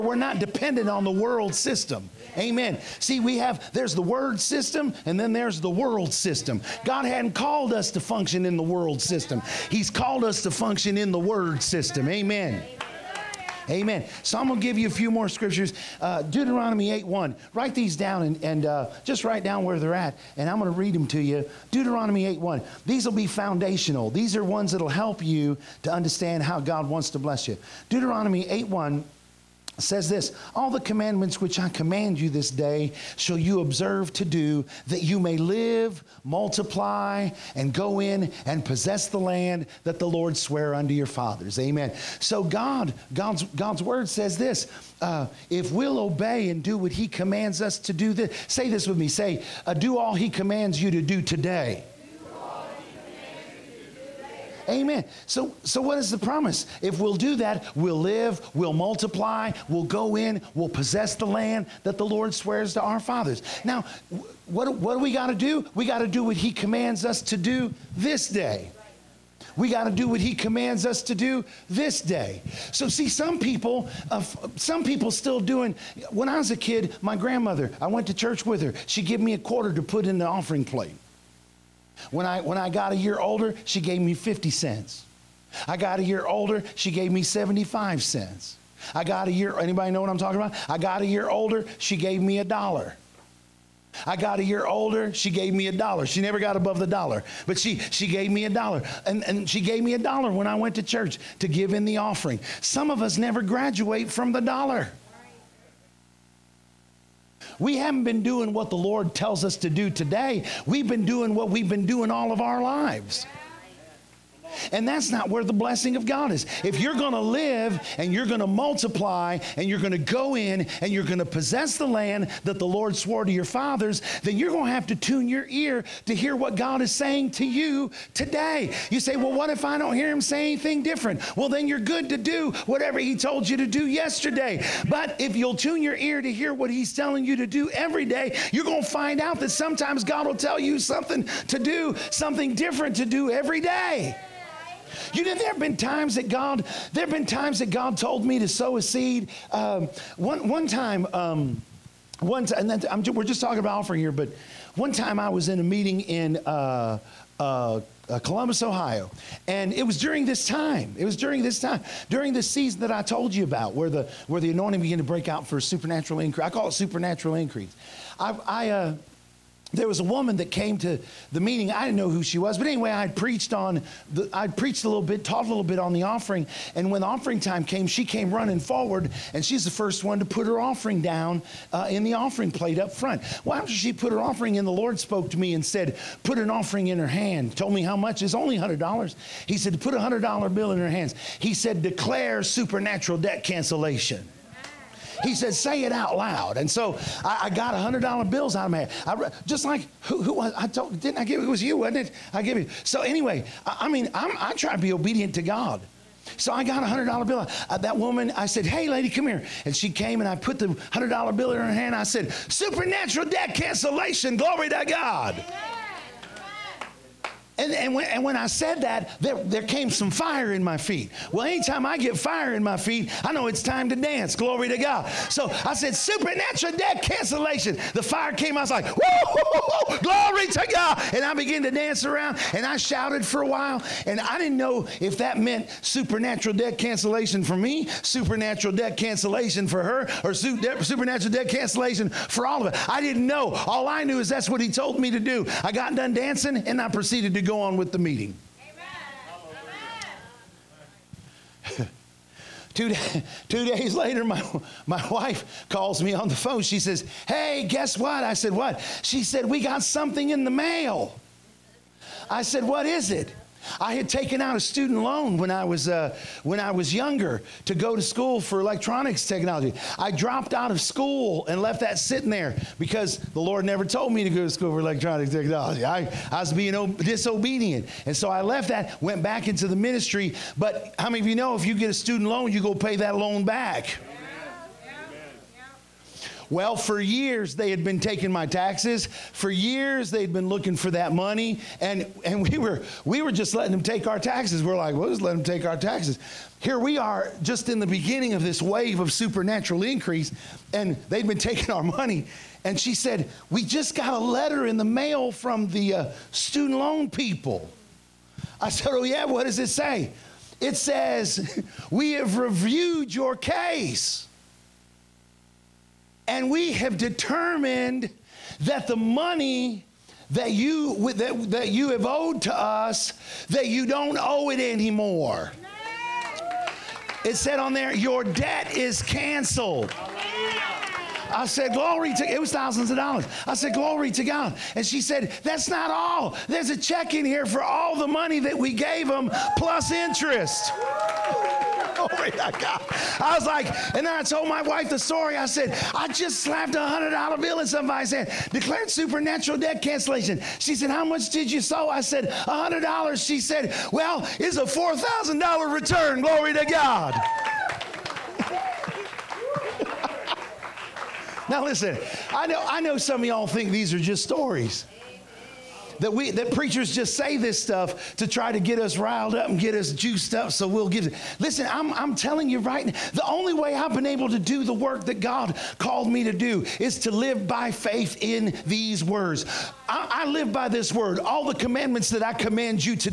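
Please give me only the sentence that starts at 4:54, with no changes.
We're like, well, just let them take our taxes.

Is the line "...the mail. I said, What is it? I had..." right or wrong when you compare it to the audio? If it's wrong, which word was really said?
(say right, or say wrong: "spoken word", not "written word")
right.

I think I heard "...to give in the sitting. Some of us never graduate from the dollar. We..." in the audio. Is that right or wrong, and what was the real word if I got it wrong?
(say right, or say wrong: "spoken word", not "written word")
wrong: "offering", not "sitting".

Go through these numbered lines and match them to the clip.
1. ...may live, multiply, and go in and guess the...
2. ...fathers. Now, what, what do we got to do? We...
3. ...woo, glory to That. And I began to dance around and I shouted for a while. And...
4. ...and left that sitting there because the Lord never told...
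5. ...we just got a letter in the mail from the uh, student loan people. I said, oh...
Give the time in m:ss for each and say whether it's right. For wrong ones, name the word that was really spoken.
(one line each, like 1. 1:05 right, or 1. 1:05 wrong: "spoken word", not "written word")
1. 0:35 wrong: "possess", not "guess"
2. 1:02 right
3. 3:48 wrong: "God", not "That"
4. 4:31 right
5. 5:03 right.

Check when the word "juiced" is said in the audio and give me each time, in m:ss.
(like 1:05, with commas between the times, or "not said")
6:09.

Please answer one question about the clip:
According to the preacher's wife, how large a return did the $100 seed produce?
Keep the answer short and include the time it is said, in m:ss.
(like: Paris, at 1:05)
$4,000, at 5:54.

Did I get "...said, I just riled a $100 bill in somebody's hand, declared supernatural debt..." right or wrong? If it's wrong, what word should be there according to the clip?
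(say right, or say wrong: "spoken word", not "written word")
wrong: "slapped", not "riled".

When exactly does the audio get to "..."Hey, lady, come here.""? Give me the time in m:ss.
3:28.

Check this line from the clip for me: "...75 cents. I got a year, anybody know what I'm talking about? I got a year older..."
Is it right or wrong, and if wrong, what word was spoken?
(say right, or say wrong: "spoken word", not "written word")
right.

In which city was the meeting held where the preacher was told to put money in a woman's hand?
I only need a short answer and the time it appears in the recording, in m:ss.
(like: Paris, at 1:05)
Columbus, Ohio, at 2:38.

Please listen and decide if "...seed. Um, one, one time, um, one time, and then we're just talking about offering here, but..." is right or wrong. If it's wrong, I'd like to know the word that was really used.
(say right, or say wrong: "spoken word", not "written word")
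right.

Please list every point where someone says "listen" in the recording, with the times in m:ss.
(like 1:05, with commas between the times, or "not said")
6:01, 6:11.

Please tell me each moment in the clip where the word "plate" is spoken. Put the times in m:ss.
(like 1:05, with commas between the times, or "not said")
1:20, 3:02.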